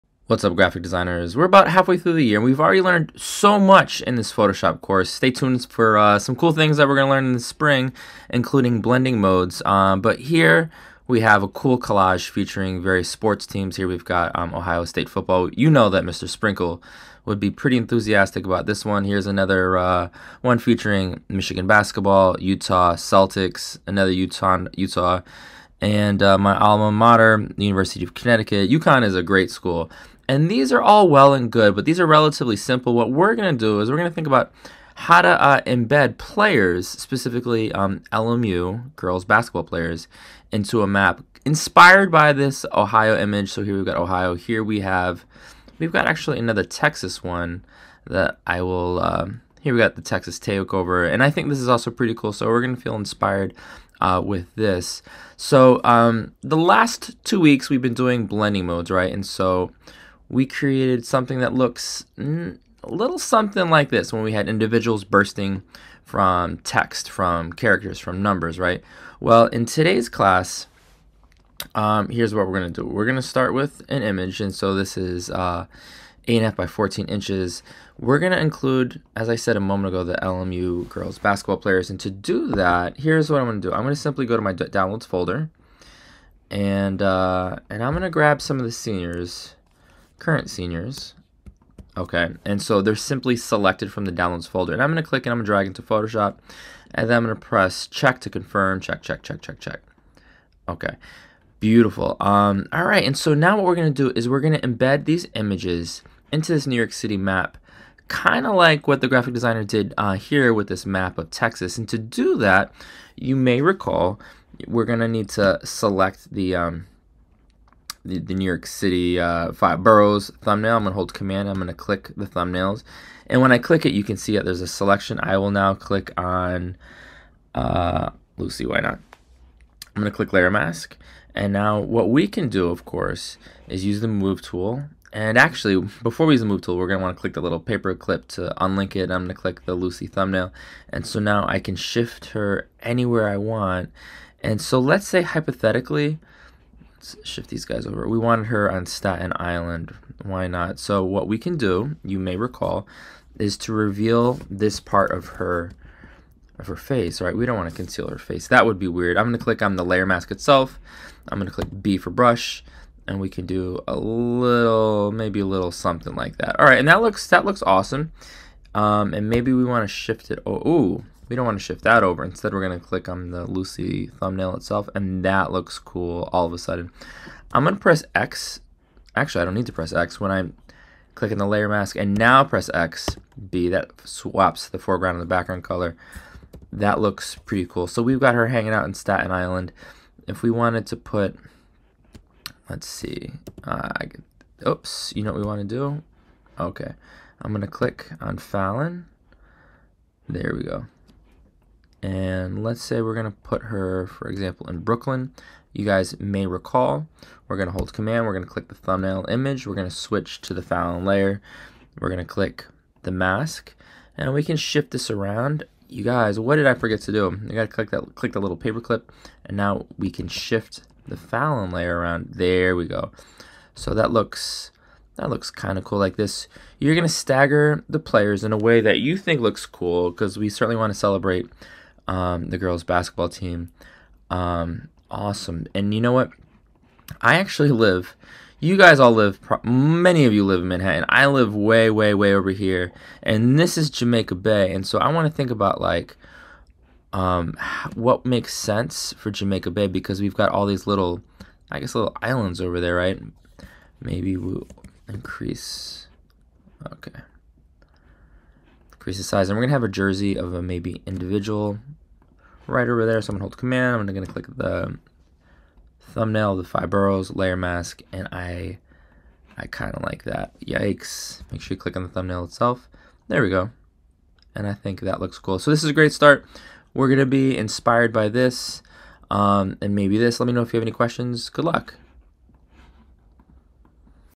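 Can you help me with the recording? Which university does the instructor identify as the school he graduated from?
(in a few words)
University of Connecticut.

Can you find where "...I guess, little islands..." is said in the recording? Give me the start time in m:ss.
4:11.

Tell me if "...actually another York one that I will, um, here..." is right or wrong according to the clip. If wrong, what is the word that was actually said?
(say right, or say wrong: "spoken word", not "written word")
wrong: "Texas", not "York".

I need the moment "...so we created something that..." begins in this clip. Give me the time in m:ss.
0:59.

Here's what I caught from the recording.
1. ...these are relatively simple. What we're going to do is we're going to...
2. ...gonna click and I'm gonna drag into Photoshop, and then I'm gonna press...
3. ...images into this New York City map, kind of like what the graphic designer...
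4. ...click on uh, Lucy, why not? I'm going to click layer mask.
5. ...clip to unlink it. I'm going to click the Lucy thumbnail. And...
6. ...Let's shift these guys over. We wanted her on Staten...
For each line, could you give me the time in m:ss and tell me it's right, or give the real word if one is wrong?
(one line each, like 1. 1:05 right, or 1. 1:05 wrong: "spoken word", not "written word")
1. 0:31 right
2. 1:34 right
3. 1:45 right
4. 2:05 right
5. 2:17 right
6. 2:27 right.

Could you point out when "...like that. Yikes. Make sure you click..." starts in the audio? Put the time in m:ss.
4:30.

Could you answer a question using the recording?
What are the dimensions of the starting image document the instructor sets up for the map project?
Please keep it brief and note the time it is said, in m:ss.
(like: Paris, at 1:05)
8.5 by 14 inches, at 1:16.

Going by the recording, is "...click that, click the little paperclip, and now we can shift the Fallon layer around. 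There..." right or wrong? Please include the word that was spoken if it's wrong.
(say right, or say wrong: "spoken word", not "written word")
right.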